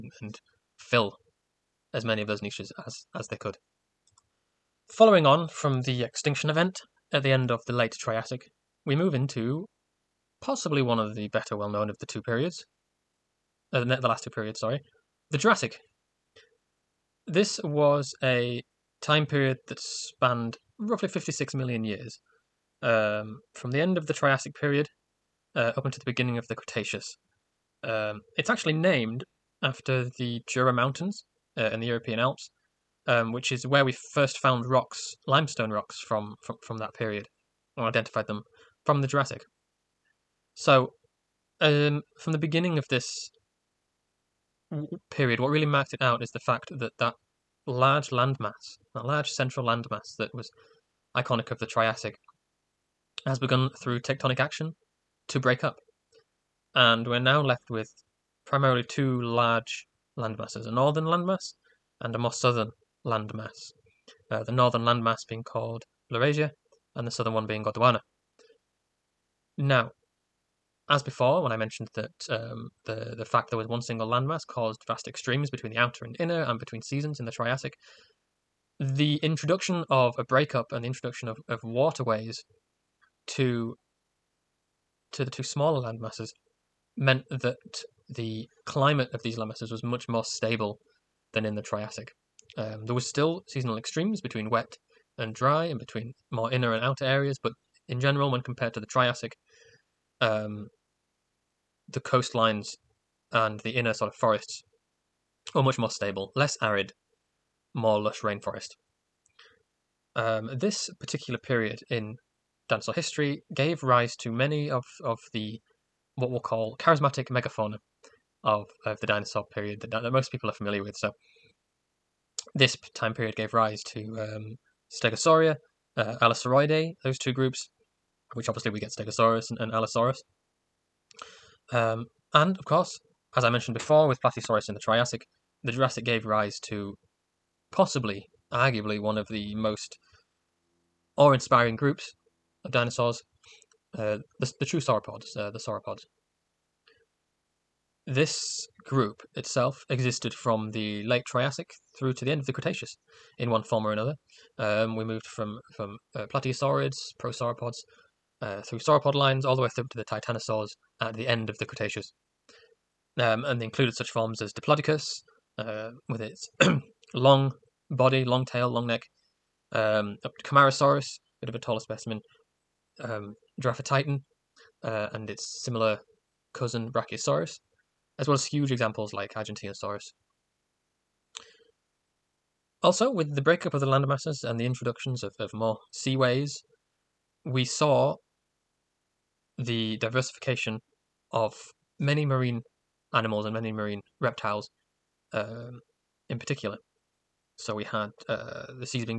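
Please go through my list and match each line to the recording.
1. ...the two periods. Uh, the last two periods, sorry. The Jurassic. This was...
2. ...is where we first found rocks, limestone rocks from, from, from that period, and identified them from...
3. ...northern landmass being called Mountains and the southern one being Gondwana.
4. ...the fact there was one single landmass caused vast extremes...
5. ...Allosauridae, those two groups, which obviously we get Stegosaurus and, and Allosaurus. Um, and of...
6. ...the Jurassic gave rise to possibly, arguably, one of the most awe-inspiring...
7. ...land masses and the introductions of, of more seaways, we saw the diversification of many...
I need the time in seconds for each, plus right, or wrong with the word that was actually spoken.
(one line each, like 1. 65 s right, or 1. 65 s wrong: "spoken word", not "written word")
1. 11 s right
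2. 33 s right
3. 64 s wrong: "Laurasia", not "Mountains"
4. 73 s right
5. 126 s right
6. 135 s right
7. 183 s right.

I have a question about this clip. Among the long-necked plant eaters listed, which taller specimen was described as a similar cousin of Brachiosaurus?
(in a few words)
Camarasaurus.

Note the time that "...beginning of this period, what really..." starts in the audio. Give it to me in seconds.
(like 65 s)
42 s.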